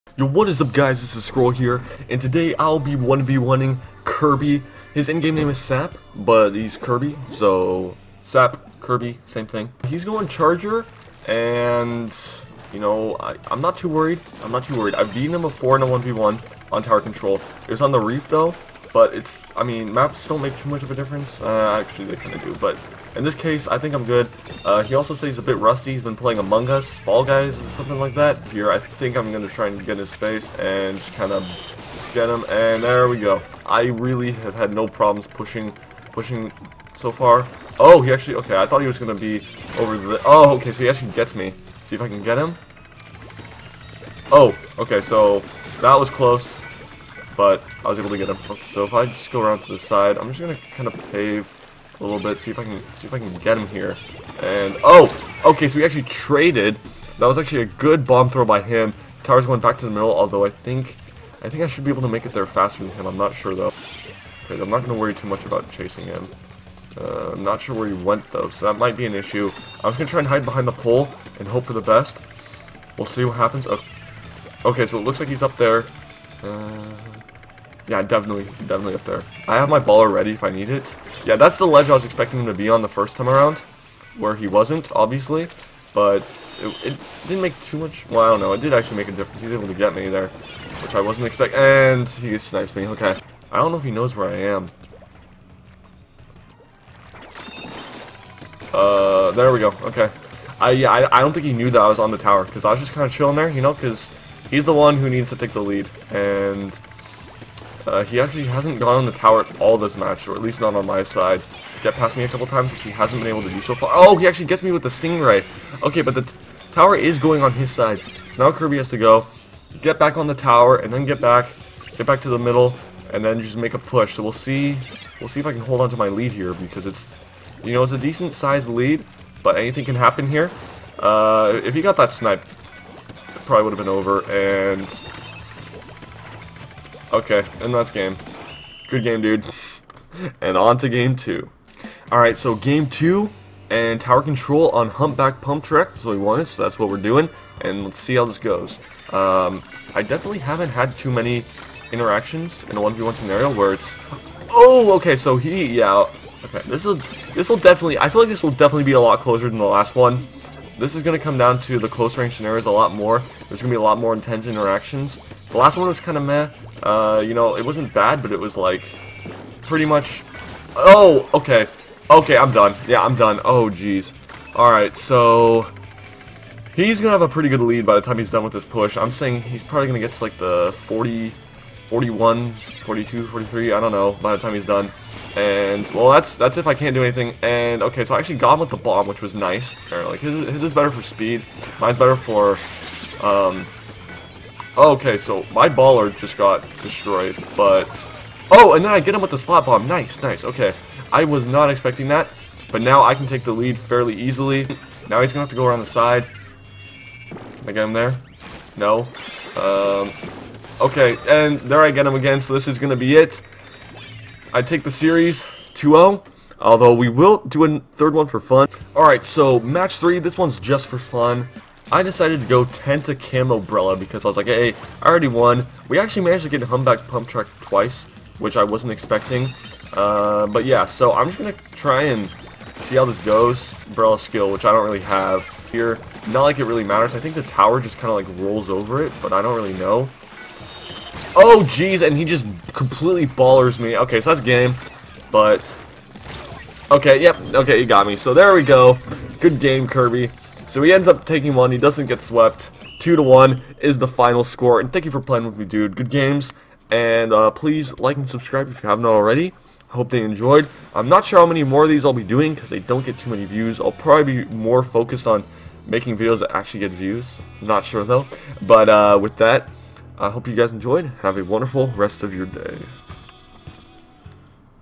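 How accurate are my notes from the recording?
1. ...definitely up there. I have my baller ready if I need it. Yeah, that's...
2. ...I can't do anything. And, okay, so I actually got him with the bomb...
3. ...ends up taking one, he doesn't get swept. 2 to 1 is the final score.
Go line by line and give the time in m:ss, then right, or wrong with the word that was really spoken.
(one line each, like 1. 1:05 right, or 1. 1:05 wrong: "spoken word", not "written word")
1. 1:18 right
2. 3:06 right
3. 4:10 right.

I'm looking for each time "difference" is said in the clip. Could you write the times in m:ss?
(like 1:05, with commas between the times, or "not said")
0:20, 1:29.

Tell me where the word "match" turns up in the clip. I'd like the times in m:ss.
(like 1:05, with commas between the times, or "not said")
1:49, 3:39.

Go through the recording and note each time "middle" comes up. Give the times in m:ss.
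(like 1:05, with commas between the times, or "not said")
0:59, 2:02.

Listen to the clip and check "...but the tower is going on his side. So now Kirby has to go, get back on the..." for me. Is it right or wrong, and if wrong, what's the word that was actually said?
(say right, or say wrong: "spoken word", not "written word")
right.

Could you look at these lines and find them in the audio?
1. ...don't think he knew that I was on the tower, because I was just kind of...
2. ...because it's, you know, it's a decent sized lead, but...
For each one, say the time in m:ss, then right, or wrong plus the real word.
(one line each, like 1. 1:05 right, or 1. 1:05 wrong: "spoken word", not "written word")
1. 1:41 right
2. 2:06 right.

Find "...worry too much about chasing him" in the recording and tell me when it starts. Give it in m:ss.
1:04.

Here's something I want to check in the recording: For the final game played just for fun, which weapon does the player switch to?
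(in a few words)
Tenta Camo Brella.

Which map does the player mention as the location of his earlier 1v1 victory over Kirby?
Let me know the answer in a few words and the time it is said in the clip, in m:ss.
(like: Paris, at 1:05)
The Reef, at 0:17.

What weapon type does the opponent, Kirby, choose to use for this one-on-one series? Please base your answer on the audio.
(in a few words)
Charger.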